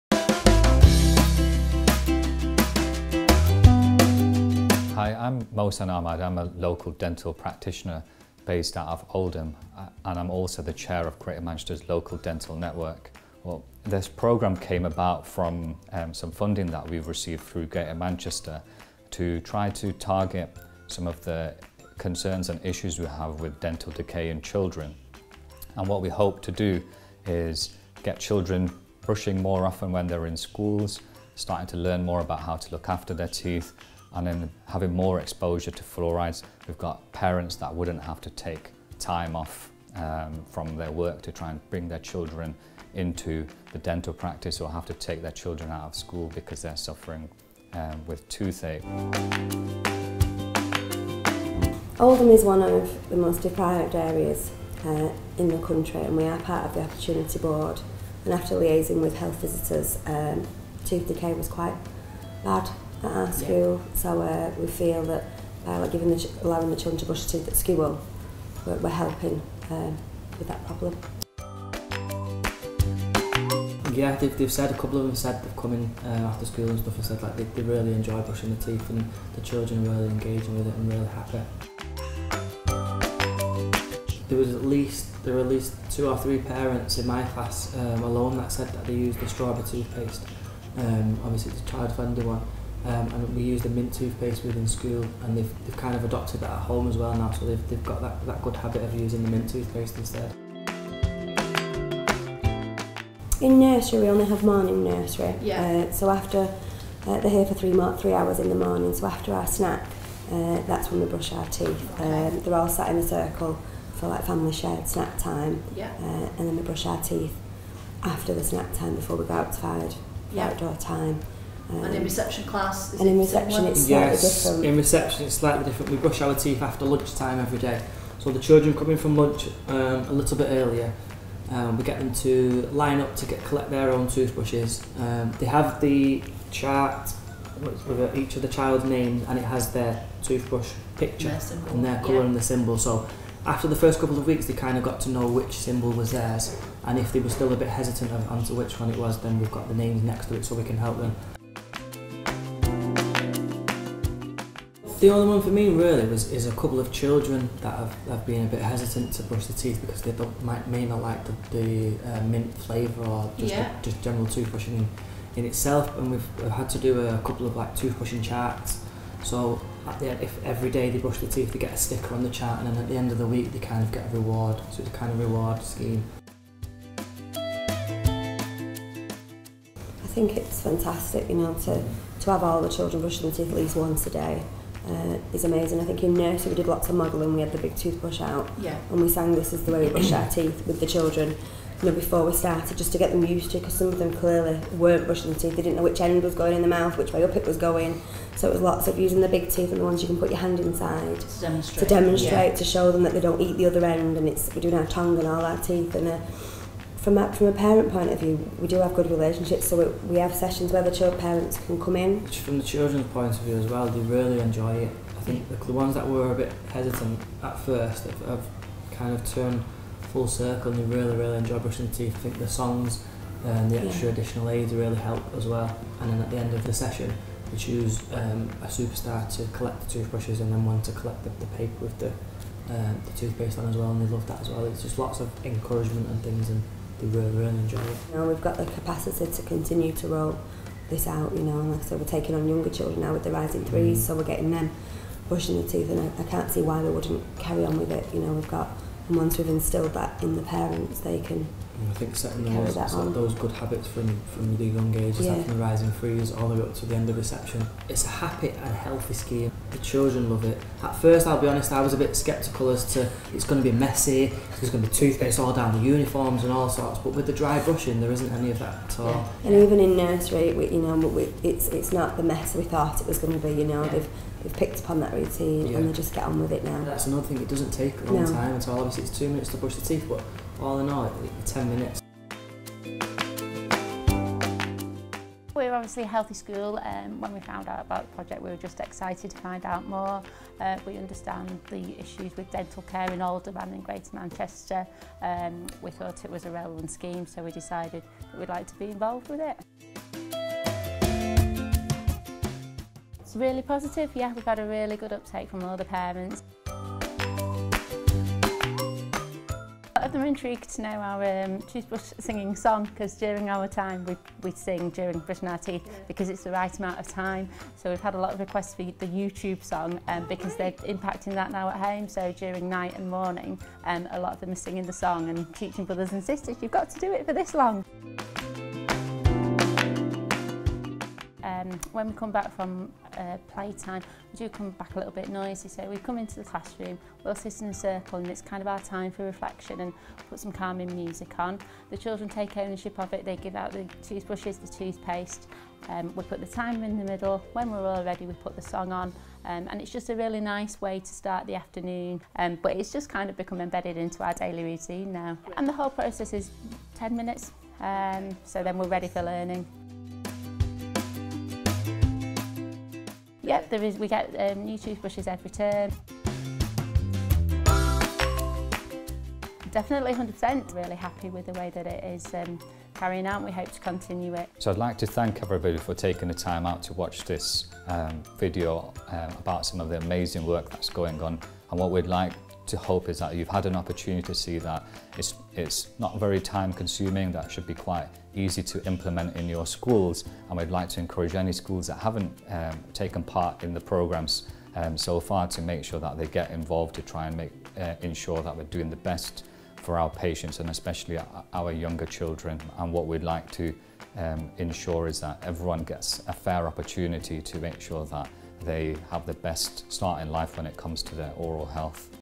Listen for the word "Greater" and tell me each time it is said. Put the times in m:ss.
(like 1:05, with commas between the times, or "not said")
0:11, 0:17, 4:53.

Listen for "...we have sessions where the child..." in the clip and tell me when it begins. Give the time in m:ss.
3:30.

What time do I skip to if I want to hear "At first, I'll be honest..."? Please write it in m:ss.
4:20.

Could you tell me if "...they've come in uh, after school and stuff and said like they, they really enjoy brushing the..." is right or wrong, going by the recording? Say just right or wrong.
right.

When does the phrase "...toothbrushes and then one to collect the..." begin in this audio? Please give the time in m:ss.
3:49.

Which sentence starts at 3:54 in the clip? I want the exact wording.
It's just lots of encouragement and things and the enjoy it.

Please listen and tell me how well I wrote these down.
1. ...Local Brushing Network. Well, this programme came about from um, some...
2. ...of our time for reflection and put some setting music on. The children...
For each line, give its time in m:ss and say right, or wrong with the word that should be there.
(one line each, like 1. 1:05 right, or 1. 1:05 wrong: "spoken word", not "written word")
1. 0:11 wrong: "Dental", not "Brushing"
2. 5:38 wrong: "calming", not "setting".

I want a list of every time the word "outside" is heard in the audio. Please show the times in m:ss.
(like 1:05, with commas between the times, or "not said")
1:59.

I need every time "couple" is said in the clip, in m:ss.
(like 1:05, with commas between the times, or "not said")
1:14, 2:23, 2:36, 2:47.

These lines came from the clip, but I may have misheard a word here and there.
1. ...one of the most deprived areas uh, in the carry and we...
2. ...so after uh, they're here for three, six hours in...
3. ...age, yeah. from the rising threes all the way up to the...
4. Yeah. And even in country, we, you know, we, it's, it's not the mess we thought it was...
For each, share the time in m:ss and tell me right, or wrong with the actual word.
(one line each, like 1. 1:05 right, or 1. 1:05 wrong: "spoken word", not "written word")
1. 0:52 wrong: "country", not "carry"
2. 1:45 wrong: "three", not "six"
3. 4:14 right
4. 4:29 wrong: "nursery", not "country".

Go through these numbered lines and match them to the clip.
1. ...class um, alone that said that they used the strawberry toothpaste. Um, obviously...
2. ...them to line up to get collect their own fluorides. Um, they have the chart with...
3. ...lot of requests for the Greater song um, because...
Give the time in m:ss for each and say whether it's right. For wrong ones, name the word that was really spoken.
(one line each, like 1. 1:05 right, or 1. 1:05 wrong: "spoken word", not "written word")
1. 1:27 right
2. 2:11 wrong: "toothbrushes", not "fluorides"
3. 5:18 wrong: "YouTube", not "Greater".